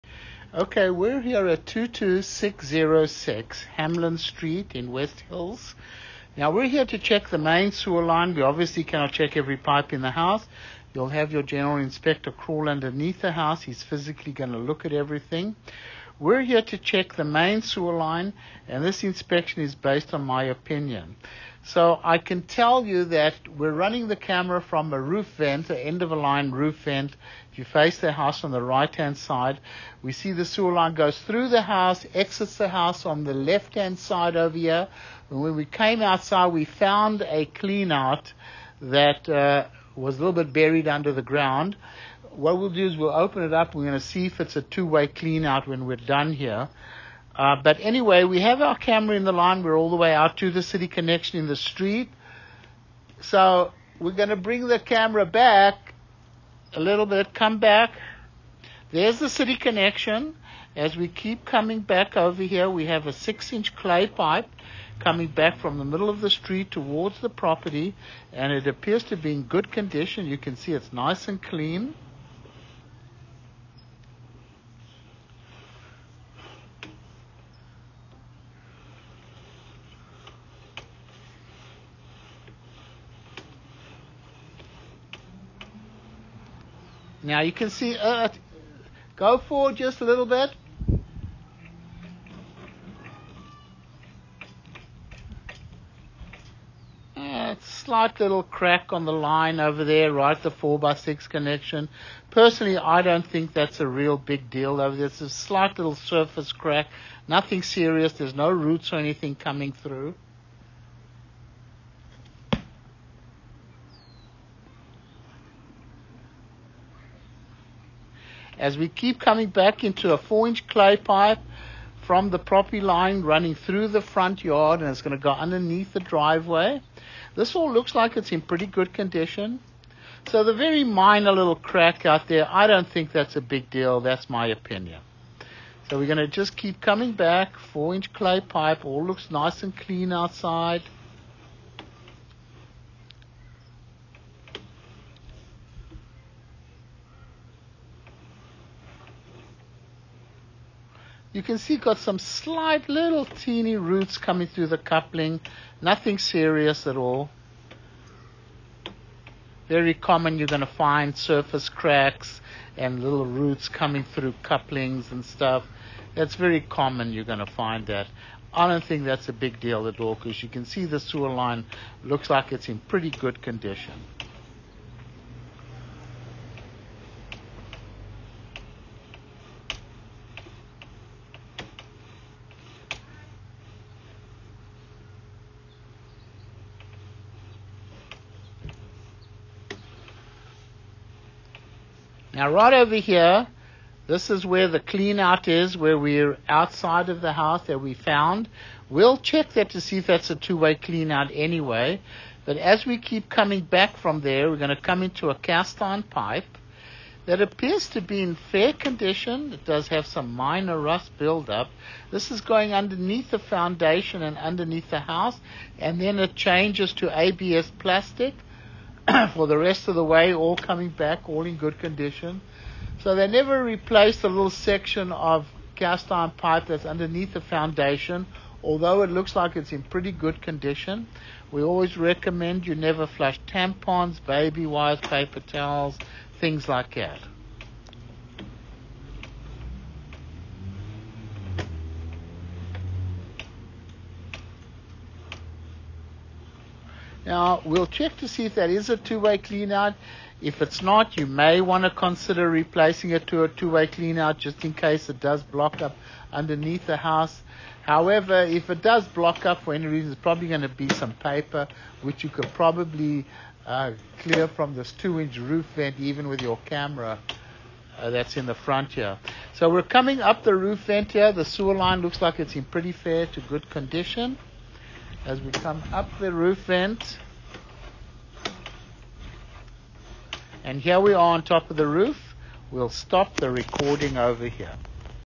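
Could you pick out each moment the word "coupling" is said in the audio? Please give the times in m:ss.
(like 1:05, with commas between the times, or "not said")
2:34, 2:44.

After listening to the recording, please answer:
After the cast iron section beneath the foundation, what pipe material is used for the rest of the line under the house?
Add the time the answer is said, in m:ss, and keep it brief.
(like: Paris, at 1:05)
ABS plastic, at 3:37.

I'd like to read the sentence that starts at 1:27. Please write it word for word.
Now you can see, uh, uh, go forward just a little bit.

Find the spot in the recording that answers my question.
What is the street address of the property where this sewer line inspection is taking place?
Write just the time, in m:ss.
0:01.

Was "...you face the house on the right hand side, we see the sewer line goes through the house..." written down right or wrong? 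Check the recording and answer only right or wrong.
right.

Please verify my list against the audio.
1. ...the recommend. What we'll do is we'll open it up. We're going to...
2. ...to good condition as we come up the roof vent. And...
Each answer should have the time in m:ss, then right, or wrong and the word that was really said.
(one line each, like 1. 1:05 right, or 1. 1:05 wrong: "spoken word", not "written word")
1. 0:41 wrong: "ground", not "recommend"
2. 4:33 right.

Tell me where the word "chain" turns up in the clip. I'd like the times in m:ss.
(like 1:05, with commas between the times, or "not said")
not said.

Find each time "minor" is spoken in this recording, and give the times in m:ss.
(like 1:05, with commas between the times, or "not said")
2:10, 3:30.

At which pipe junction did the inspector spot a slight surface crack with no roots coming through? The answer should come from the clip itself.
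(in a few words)
4x6 connection.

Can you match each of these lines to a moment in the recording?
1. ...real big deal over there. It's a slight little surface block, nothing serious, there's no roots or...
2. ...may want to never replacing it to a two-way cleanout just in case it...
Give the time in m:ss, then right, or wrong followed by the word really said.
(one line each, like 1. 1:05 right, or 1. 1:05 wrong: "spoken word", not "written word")
1. 1:43 wrong: "crack", not "block"
2. 4:11 wrong: "consider", not "never".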